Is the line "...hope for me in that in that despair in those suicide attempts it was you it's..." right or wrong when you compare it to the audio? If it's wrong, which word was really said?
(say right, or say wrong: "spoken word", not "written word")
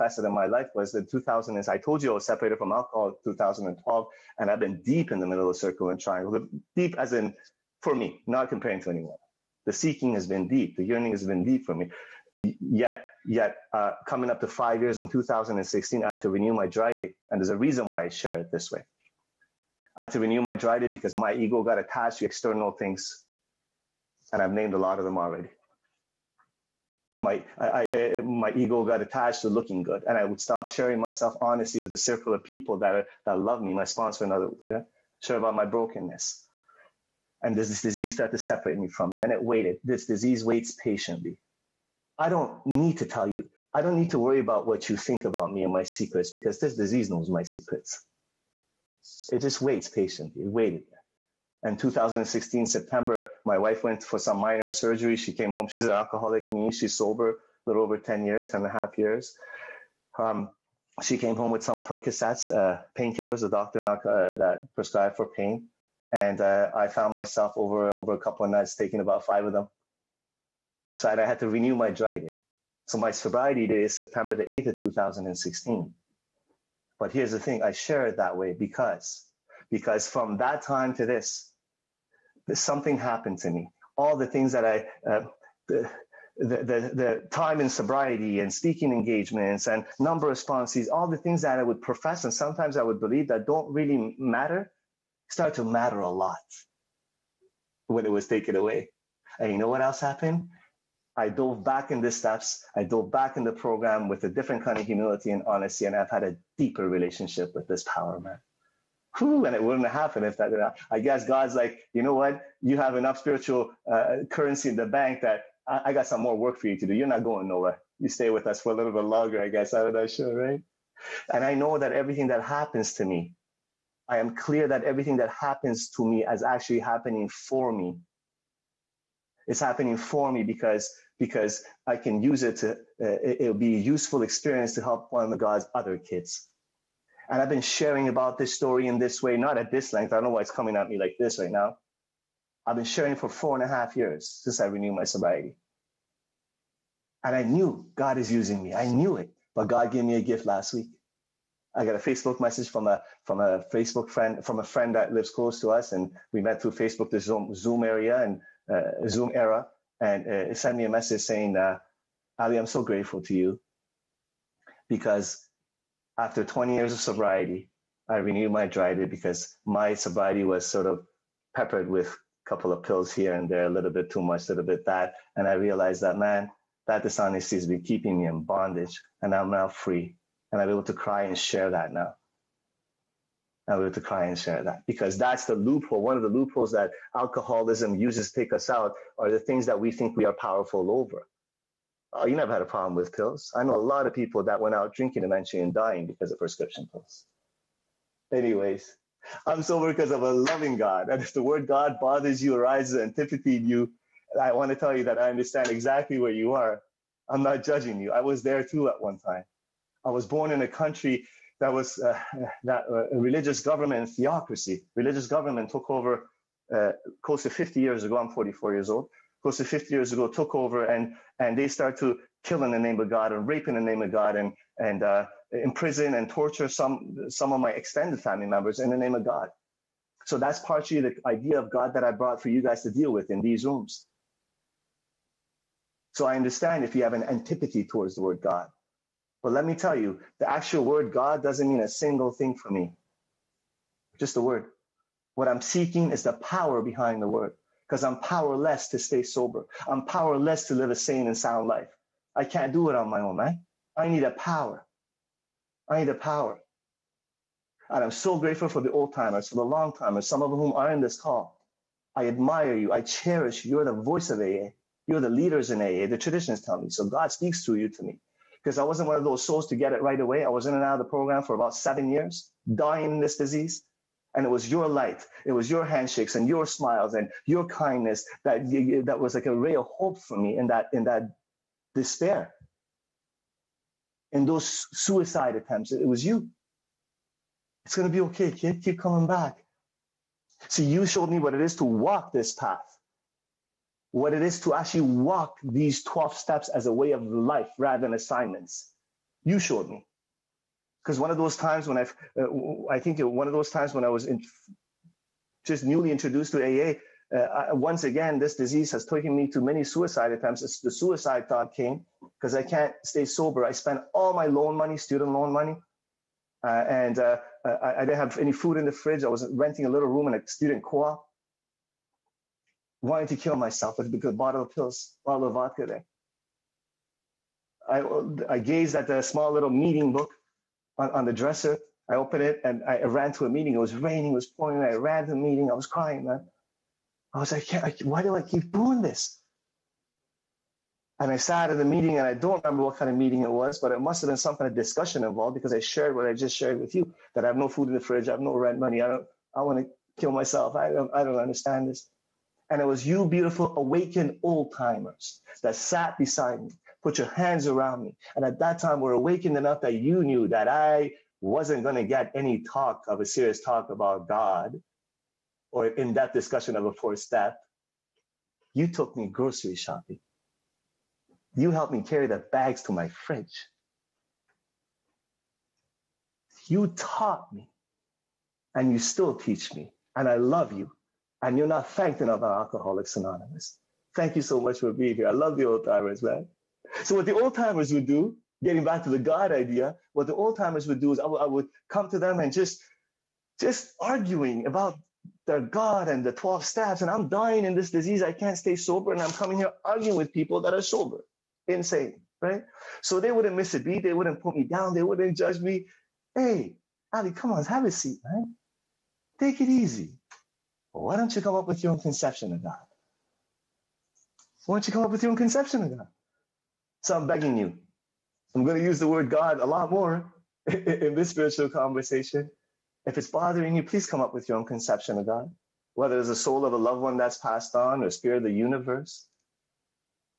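right.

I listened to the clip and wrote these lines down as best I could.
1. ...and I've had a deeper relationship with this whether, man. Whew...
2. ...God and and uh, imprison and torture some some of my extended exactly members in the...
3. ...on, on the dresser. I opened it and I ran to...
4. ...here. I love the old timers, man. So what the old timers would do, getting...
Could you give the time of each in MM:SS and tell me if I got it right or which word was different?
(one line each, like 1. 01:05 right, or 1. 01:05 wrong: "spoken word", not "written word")
1. 01:45 wrong: "power", not "whether"
2. 03:44 wrong: "family", not "exactly"
3. 05:30 right
4. 06:25 right.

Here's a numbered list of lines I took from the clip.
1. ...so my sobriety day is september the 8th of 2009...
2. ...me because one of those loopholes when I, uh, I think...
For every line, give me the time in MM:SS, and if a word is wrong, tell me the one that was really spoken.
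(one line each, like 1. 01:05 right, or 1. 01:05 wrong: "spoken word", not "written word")
1. 01:12 wrong: "2016", not "2009"
2. 04:59 wrong: "times", not "loopholes".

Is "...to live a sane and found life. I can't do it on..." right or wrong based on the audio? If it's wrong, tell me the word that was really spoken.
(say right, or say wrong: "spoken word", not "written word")
wrong: "sound", not "found".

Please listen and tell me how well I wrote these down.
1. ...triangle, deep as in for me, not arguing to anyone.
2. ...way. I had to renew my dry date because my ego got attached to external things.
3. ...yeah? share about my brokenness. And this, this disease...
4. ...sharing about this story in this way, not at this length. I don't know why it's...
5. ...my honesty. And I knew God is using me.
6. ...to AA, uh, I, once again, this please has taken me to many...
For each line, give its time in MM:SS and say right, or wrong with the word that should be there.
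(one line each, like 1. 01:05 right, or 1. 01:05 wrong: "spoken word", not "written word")
1. 00:06 wrong: "comparing", not "arguing"
2. 00:18 right
3. 00:34 right
4. 02:17 right
5. 02:24 wrong: "sobriety", not "honesty"
6. 05:06 wrong: "disease", not "please".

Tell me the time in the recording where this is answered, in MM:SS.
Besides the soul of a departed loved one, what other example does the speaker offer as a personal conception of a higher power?
07:08.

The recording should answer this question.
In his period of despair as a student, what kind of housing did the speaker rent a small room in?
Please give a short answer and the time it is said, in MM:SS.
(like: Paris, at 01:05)
A student co-op, at 05:20.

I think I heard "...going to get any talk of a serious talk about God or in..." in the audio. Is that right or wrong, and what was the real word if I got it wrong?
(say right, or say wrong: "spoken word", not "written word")
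right.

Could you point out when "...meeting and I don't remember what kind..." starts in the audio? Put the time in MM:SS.
05:41.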